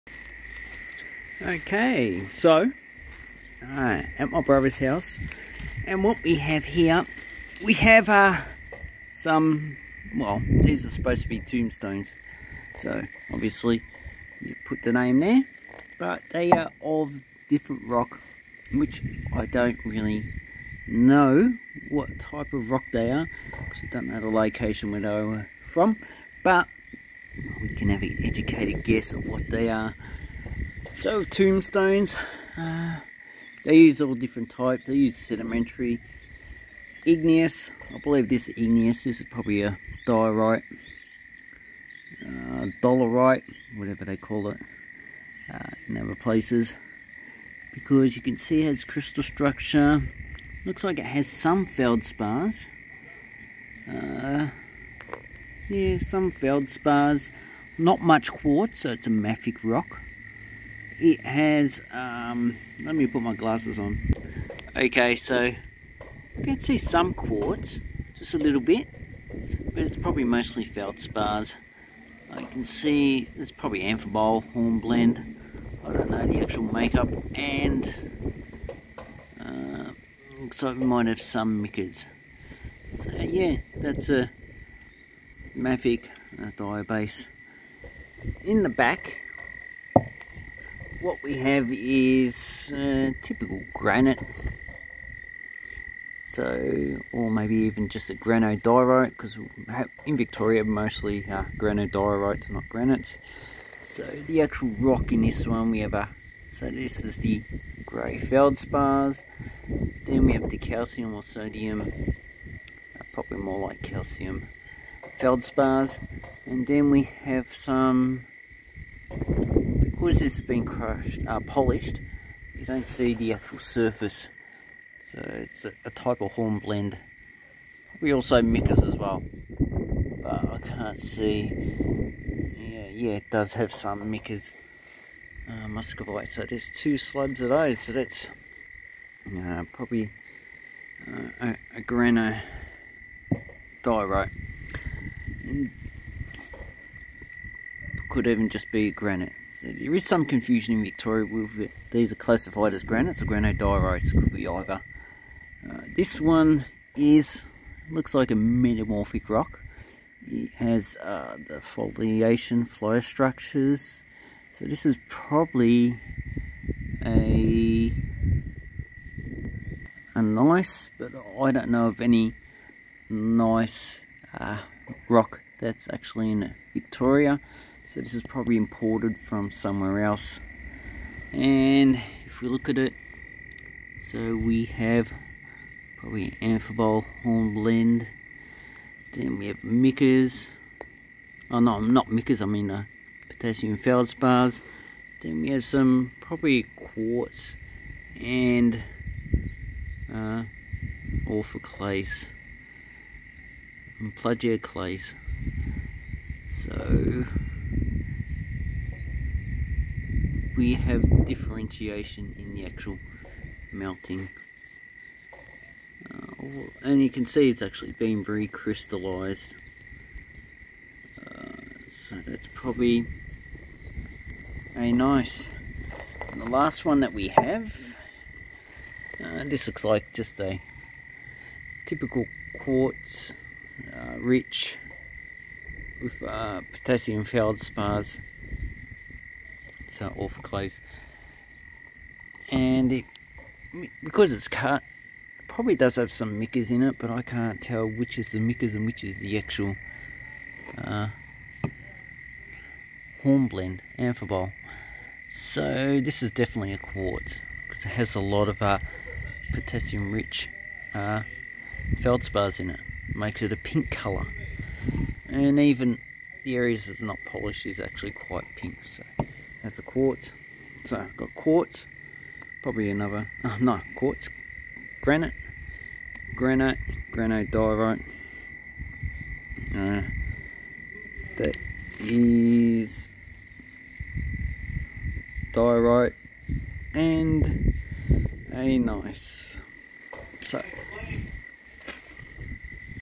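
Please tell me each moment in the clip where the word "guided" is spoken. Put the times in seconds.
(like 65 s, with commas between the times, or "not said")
not said.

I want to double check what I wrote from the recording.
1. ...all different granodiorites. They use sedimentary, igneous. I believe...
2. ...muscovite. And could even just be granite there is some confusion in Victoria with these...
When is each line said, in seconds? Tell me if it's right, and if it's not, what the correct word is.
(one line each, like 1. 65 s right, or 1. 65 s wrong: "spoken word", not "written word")
1. 34 s wrong: "types", not "granodiorites"
2. 143 s wrong: "diorite", not "muscovite".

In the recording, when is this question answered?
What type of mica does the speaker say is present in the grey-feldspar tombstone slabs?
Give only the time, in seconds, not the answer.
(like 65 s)
135 s.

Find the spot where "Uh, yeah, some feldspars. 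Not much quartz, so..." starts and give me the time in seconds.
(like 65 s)
53 s.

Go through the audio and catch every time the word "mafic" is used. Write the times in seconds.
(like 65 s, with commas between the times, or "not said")
59 s, 85 s.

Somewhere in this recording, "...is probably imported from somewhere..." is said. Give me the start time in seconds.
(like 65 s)
178 s.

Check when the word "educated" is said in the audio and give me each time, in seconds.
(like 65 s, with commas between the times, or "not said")
28 s.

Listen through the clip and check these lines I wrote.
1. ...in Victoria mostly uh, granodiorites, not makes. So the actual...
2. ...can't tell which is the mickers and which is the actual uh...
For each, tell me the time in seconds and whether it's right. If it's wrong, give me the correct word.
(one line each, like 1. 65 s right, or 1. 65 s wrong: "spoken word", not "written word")
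1. 100 s wrong: "granites", not "makes"
2. 247 s right.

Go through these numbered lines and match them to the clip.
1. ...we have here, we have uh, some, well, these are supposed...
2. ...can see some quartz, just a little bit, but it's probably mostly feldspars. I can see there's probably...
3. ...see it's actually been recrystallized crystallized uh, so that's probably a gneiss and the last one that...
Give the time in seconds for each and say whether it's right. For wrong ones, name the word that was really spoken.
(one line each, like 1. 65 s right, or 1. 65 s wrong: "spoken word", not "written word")
1. 6 s right
2. 66 s right
3. 217 s right.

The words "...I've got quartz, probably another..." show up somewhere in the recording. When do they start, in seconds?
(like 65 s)
270 s.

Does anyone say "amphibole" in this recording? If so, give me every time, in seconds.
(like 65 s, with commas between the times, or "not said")
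73 s, 186 s, 253 s.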